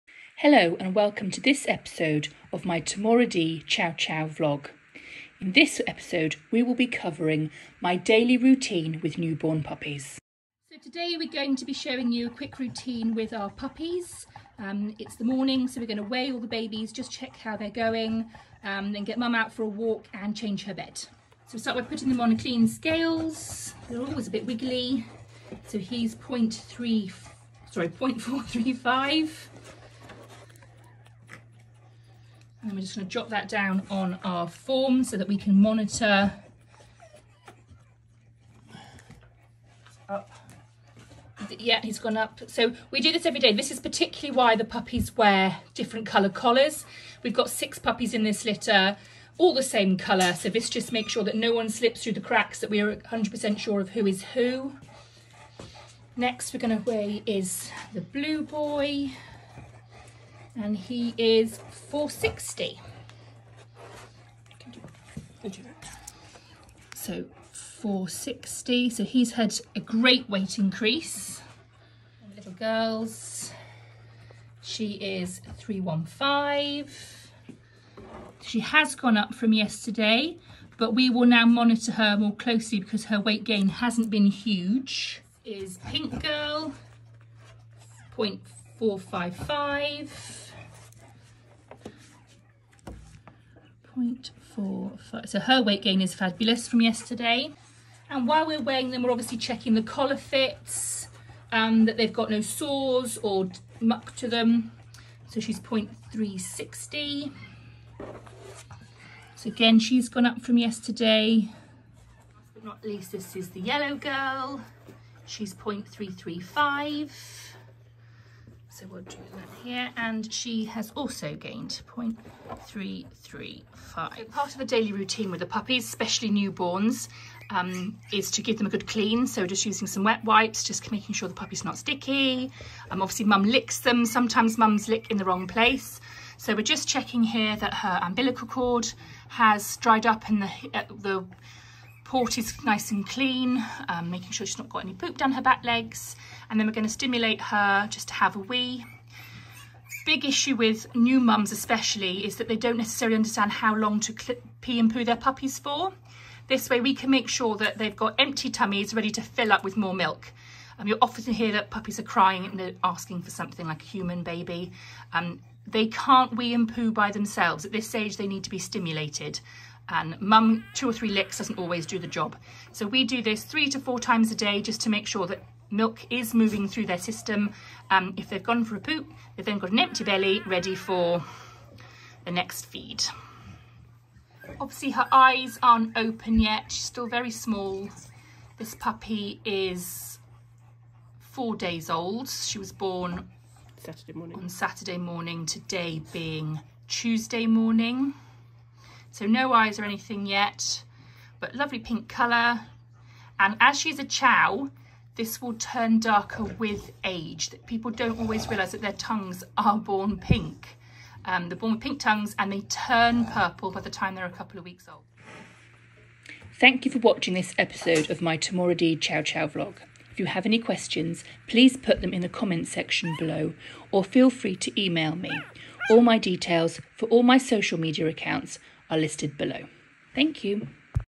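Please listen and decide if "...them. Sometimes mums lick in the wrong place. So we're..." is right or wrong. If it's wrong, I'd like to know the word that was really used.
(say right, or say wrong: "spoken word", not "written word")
right.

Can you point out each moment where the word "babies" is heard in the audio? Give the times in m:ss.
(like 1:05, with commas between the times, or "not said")
0:16.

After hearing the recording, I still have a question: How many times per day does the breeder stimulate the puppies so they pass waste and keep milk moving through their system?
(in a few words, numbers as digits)
3 to 4.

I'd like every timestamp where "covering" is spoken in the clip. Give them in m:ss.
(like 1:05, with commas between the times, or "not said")
0:06.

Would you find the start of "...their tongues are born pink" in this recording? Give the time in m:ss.
3:28.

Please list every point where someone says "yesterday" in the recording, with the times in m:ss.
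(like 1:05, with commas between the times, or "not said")
1:19, 1:36, 1:50.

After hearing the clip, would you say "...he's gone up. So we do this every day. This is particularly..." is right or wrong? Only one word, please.
right.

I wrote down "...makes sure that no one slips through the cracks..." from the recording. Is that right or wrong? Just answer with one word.
right.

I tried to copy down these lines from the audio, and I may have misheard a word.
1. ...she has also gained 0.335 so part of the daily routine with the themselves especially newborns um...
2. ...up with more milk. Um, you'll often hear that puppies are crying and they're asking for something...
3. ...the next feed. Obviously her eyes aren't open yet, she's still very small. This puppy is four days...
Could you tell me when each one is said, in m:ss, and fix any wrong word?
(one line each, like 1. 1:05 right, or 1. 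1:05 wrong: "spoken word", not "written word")
1. 2:00 wrong: "puppies", not "themselves"
2. 2:39 right
3. 3:02 right.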